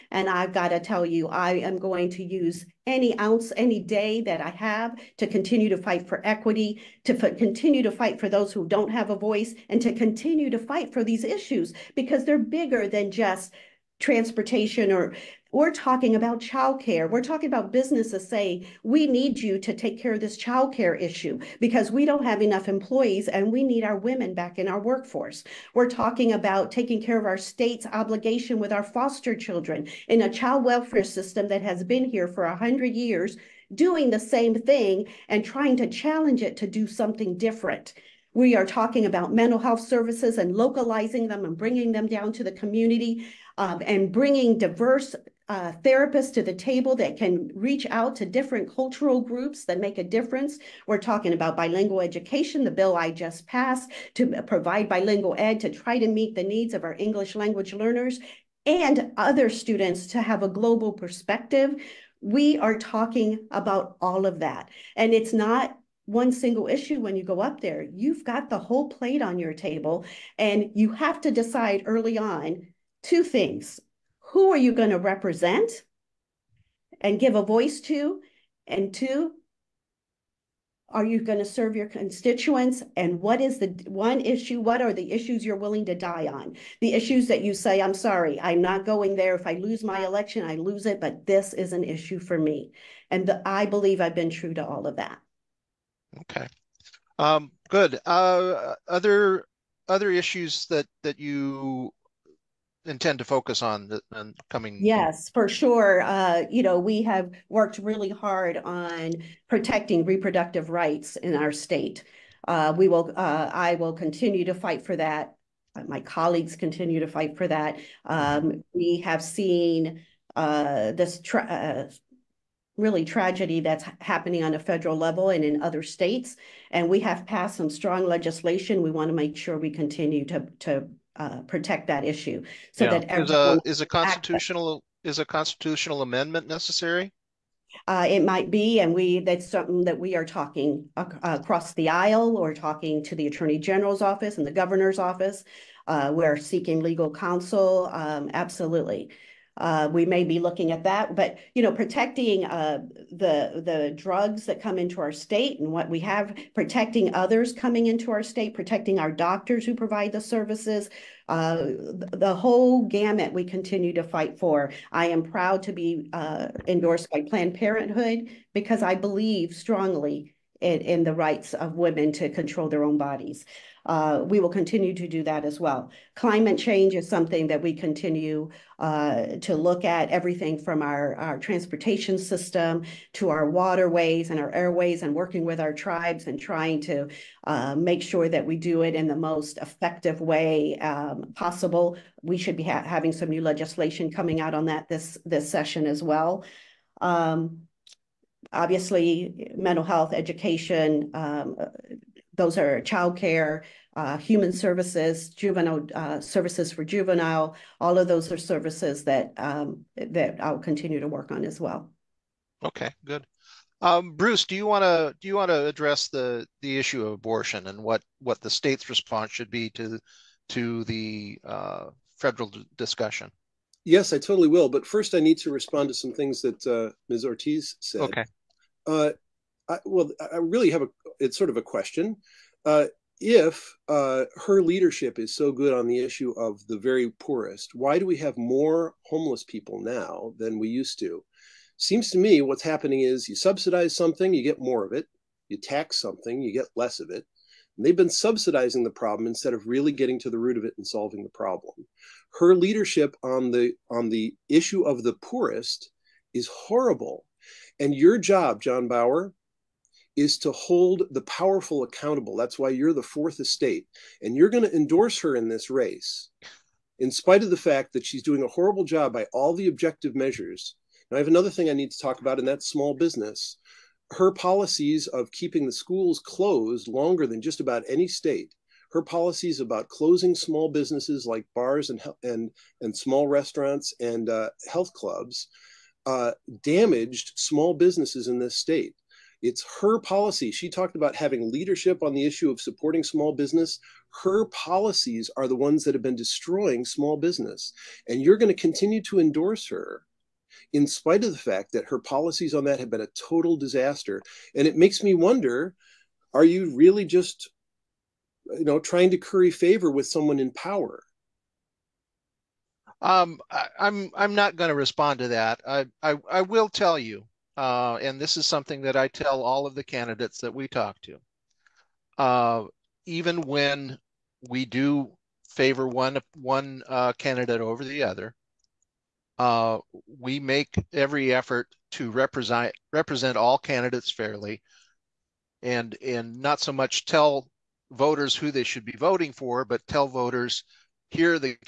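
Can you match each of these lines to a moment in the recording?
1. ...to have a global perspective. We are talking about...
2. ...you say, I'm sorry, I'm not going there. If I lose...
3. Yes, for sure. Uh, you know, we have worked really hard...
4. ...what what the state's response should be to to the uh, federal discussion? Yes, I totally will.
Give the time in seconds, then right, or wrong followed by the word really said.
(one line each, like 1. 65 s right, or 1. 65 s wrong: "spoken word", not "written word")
1. 60 s right
2. 87 s right
3. 104 s right
4. 217 s right.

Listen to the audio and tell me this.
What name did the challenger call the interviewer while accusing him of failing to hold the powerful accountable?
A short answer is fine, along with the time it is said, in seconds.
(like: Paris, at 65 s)
Jon Bauer, at 258 s.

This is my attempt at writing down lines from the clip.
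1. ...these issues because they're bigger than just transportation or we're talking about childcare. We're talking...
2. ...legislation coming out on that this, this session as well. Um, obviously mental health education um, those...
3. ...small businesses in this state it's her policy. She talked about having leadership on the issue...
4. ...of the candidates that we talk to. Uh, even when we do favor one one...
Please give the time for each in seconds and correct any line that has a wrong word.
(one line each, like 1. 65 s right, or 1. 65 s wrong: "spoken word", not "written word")
1. 11 s right
2. 193 s right
3. 287 s right
4. 319 s right.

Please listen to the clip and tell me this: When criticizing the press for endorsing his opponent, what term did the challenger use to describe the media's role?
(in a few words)
the fourth estate.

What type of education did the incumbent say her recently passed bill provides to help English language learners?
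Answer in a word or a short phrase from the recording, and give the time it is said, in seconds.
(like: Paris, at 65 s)
bilingual education, at 54 s.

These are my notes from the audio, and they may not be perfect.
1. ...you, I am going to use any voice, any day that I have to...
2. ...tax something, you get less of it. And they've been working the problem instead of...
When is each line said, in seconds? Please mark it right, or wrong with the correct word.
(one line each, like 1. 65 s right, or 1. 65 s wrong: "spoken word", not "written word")
1. 1 s wrong: "ounce", not "voice"
2. 245 s wrong: "subsidizing", not "working".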